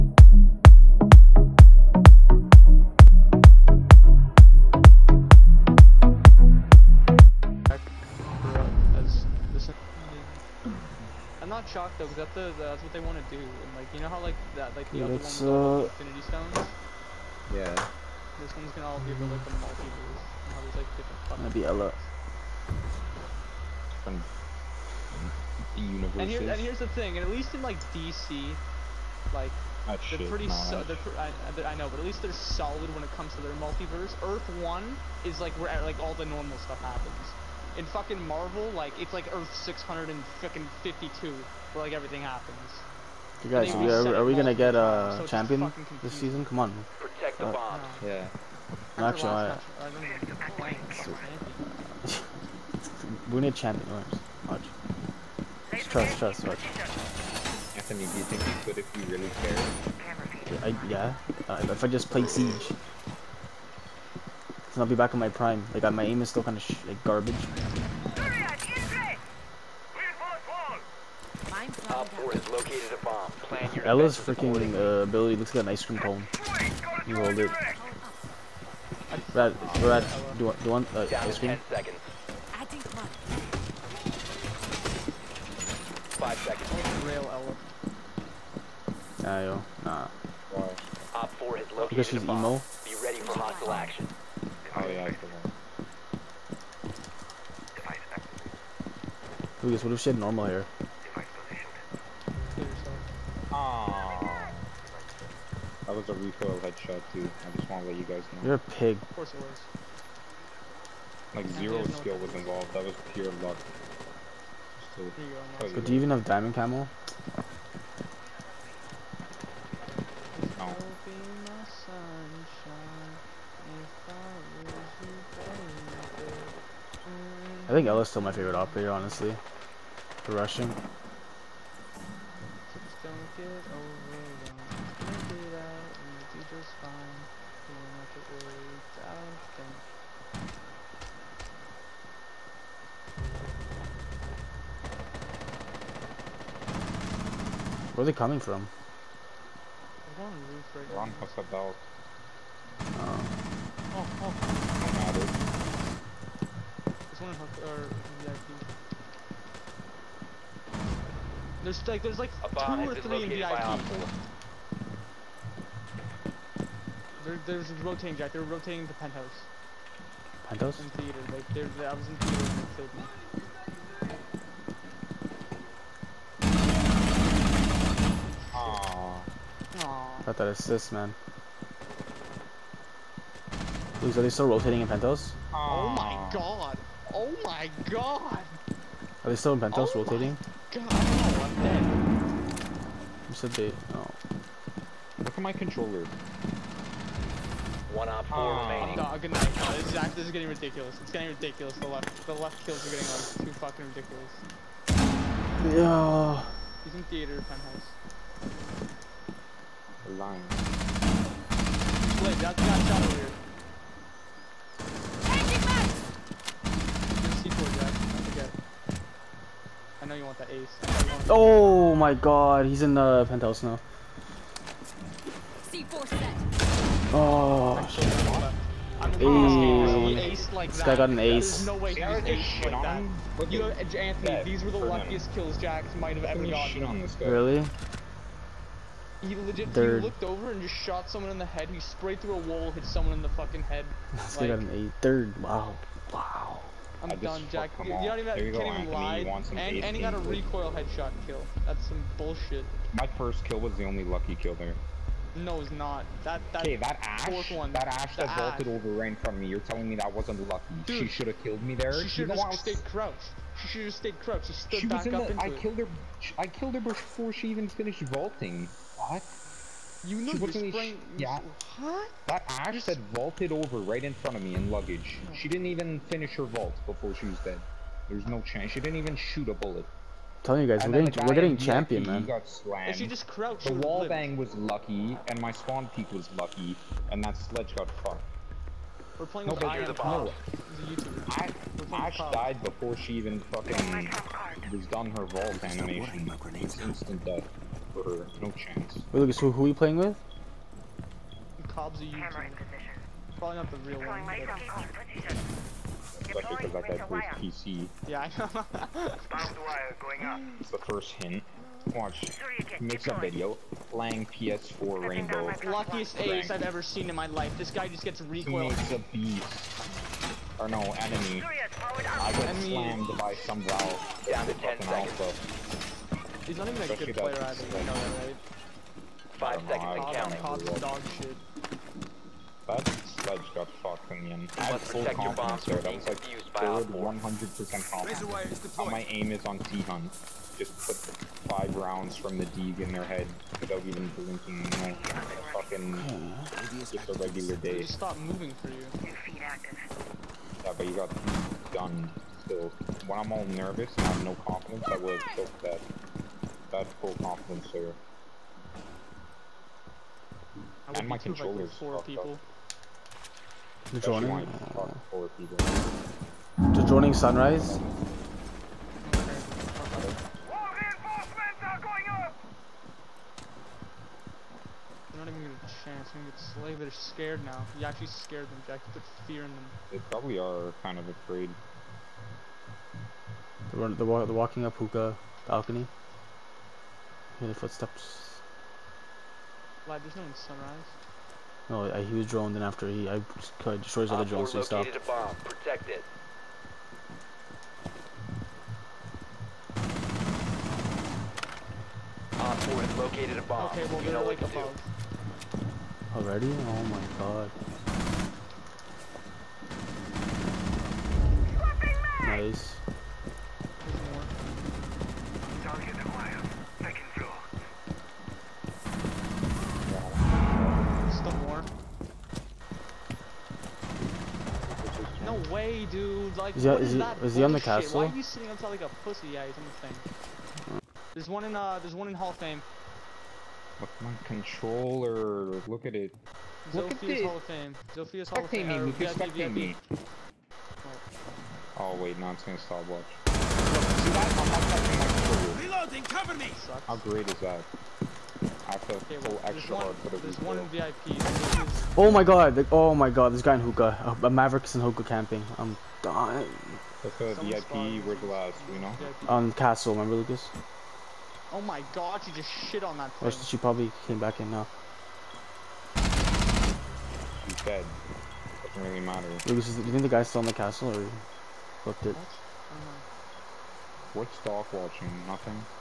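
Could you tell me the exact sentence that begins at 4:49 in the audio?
We're playing with Iron the bomb.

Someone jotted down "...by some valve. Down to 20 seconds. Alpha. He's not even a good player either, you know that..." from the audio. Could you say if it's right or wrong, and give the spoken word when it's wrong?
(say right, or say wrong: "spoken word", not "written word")
wrong: "10", not "20".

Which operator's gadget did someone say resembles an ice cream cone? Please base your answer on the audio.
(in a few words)
Ela.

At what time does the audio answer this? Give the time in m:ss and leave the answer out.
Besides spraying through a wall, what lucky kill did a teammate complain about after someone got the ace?
4:10.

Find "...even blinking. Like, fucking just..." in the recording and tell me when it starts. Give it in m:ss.
5:43.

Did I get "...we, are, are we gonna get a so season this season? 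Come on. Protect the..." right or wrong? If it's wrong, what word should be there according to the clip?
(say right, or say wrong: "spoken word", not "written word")
wrong: "champion", not "season".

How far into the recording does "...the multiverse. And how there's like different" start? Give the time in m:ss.
0:19.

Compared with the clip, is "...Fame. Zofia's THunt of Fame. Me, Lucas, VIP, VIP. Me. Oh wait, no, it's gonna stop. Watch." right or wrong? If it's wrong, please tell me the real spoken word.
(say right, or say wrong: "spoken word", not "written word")
wrong: "Hall", not "THunt".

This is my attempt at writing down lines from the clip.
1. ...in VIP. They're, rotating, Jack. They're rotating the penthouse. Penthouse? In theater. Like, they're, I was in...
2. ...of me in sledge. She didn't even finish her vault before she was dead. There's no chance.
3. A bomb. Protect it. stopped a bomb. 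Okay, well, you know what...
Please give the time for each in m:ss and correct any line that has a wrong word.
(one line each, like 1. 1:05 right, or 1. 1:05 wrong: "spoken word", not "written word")
1. 2:43 right
2. 4:34 wrong: "luggage", not "sledge"
3. 6:34 wrong: "located", not "stopped".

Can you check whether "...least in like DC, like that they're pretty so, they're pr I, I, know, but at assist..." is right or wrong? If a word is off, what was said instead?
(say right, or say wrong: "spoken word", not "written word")
wrong: "least", not "assist".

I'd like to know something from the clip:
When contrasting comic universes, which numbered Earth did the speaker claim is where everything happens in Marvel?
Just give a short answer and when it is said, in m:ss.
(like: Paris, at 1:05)
Earth 652, at 0:39.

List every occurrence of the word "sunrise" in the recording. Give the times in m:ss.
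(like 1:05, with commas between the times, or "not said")
6:07, 6:30.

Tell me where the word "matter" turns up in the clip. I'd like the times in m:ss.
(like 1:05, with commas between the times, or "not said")
2:34, 7:49.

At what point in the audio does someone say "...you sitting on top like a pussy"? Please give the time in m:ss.
7:08.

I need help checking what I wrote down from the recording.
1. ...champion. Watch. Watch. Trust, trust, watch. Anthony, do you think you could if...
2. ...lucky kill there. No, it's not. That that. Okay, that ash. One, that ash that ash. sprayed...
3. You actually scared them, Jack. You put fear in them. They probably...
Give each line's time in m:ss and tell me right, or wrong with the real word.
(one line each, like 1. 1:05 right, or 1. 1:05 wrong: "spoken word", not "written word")
1. 0:53 right
2. 4:14 wrong: "vaulted", not "sprayed"
3. 6:17 right.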